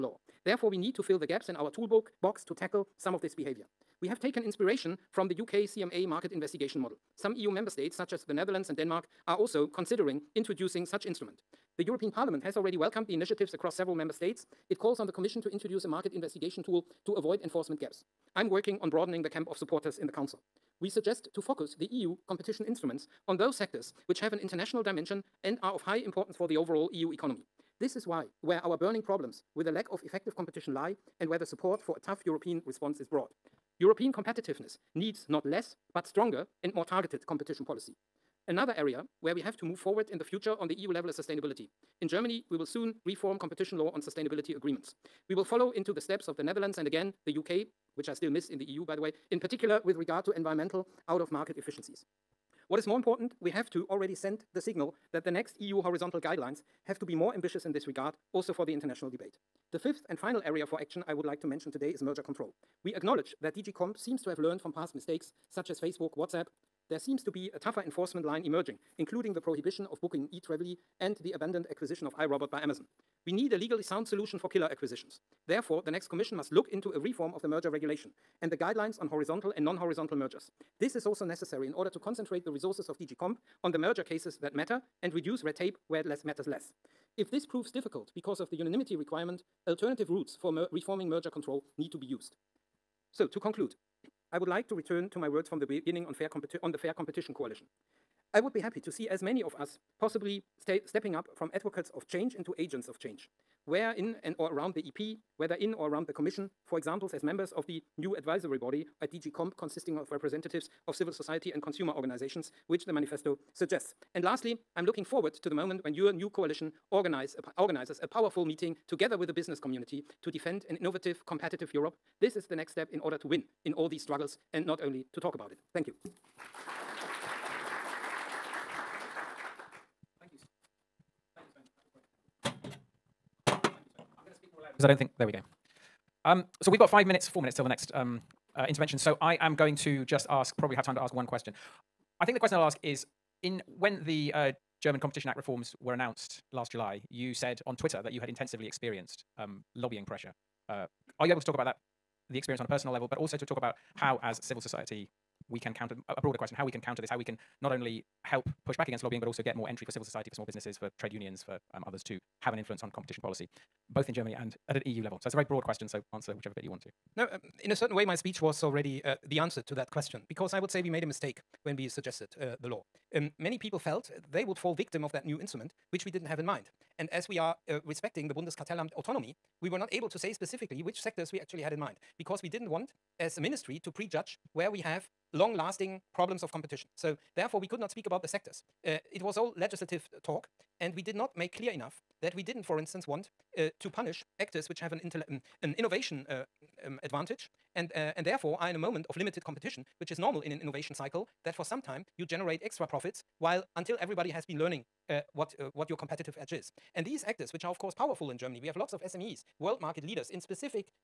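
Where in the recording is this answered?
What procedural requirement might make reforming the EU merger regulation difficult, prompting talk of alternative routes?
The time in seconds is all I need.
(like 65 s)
88 s.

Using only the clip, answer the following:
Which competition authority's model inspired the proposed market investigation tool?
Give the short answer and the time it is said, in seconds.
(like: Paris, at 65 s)
UK CMA, at 5 s.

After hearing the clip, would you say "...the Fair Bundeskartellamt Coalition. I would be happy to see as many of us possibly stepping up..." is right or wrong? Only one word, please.
wrong.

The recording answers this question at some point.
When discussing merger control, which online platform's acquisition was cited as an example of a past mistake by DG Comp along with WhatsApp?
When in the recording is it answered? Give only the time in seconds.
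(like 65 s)
65 s.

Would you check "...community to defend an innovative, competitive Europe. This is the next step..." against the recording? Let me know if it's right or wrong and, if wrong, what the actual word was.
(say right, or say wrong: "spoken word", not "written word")
right.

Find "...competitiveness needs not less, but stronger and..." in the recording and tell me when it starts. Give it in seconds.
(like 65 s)
34 s.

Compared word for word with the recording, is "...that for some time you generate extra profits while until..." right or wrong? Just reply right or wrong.
right.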